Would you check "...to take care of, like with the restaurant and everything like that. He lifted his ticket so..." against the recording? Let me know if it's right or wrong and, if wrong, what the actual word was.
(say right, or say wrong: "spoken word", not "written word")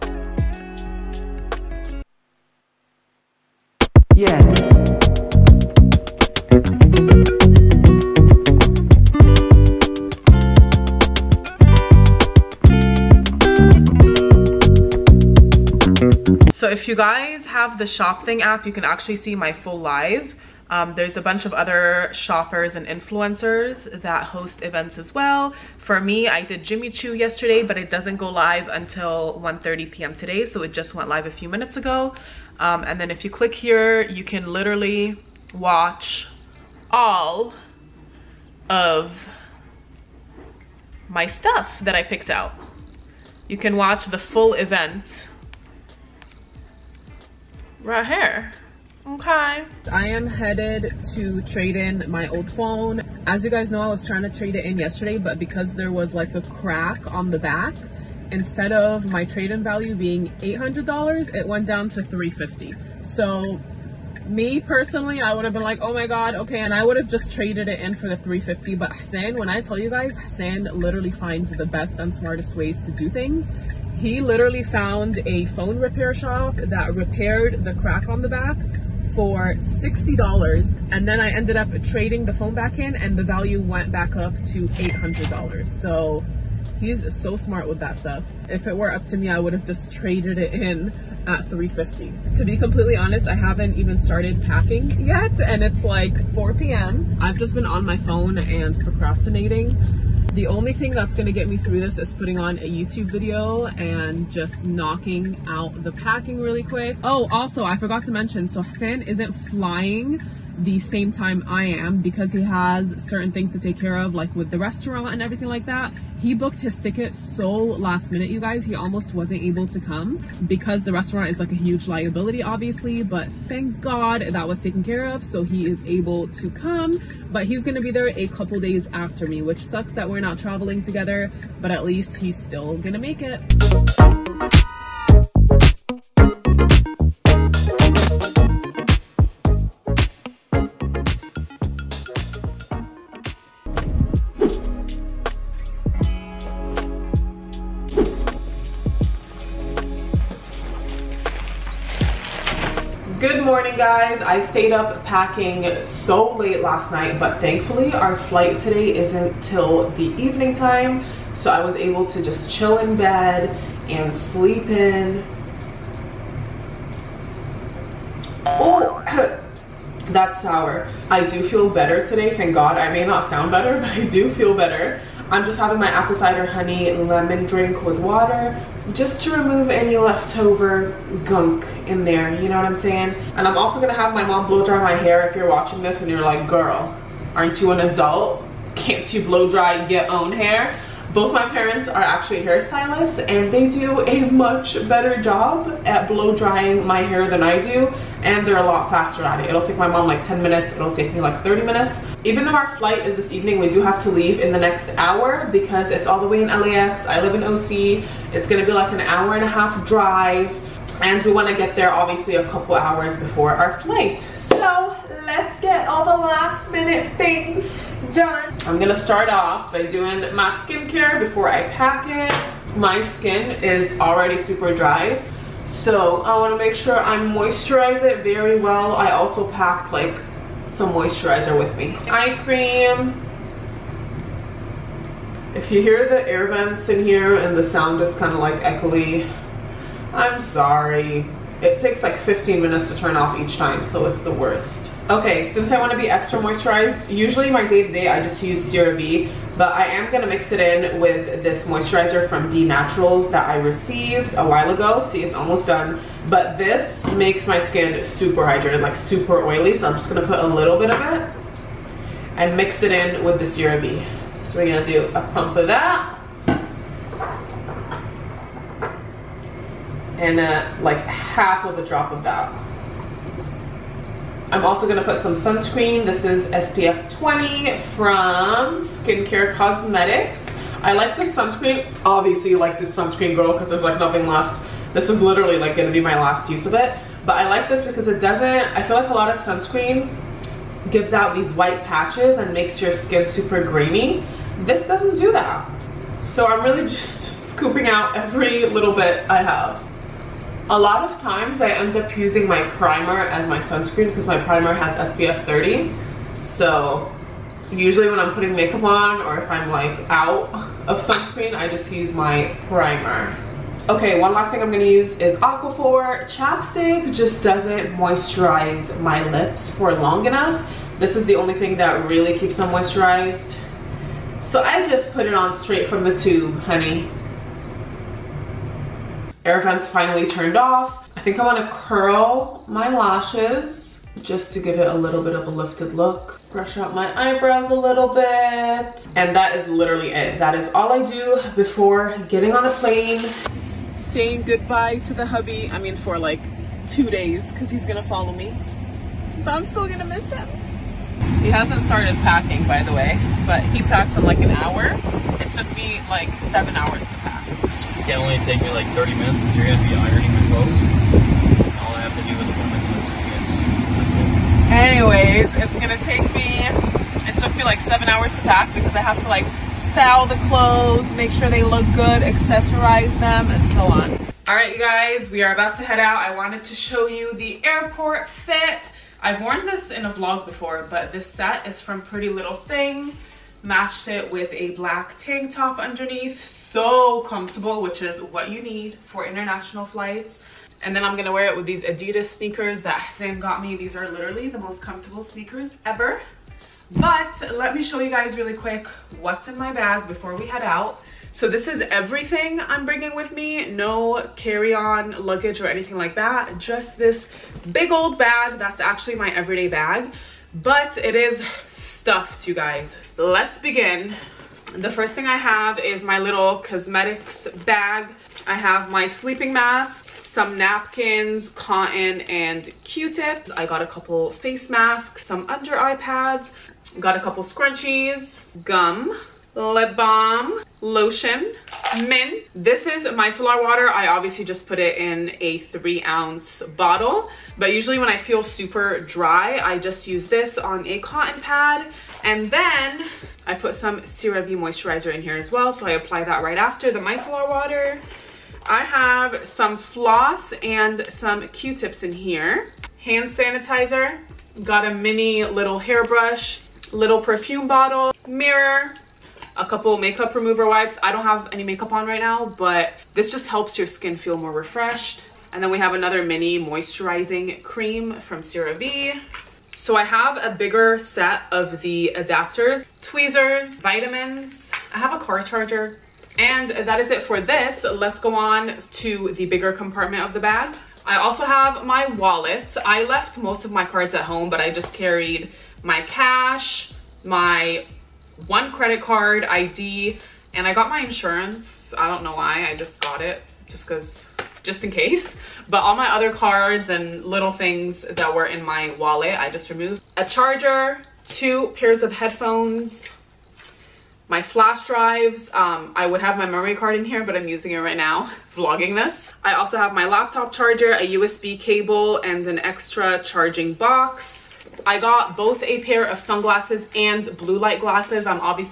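wrong: "booked", not "lifted".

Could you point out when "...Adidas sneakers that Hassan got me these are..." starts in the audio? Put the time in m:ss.
6:31.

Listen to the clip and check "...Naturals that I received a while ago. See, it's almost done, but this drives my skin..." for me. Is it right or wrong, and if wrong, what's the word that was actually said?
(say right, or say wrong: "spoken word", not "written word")
wrong: "makes", not "drives".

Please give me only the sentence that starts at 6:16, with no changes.
I wanted to show you the airport fit.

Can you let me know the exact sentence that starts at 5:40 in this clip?
That is all I do before getting on a plane.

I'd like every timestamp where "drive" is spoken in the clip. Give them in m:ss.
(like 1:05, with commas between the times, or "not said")
3:29, 8:24.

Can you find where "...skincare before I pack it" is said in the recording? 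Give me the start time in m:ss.
3:40.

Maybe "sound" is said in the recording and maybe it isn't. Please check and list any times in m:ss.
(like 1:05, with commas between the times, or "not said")
2:53, 3:57.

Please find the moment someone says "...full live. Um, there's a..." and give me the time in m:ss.
0:19.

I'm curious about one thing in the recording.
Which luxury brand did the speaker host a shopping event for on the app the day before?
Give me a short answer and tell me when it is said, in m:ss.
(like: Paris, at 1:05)
Jimmy Choo, at 0:26.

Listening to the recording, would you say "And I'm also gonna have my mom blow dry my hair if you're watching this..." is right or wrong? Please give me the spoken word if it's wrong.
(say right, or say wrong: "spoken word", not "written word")
right.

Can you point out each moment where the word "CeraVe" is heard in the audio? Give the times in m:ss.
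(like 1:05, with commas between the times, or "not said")
4:08, 4:23, 7:24, 7:48.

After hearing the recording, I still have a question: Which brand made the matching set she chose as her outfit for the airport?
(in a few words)
Pretty Little Thing.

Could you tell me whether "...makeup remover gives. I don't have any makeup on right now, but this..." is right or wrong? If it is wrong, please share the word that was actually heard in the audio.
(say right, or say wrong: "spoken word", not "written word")
wrong: "wipes", not "gives".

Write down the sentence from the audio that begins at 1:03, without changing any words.
So me personally, I would have been like, oh my God, okay.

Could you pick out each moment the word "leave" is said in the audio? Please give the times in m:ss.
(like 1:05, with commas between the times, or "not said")
3:24.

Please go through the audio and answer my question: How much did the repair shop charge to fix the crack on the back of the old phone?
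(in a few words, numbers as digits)
$60.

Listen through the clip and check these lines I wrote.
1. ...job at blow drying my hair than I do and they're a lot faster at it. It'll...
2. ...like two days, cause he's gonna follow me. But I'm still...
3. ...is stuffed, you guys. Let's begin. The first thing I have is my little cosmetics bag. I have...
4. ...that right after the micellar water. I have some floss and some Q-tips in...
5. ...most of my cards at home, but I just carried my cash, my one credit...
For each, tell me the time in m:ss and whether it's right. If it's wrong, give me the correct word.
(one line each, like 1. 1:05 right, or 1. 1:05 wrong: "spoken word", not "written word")
1. 3:15 right
2. 5:46 right
3. 6:51 right
4. 7:26 right
5. 8:03 right.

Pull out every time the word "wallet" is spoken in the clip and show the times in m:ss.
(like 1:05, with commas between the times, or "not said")
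8:02, 8:18.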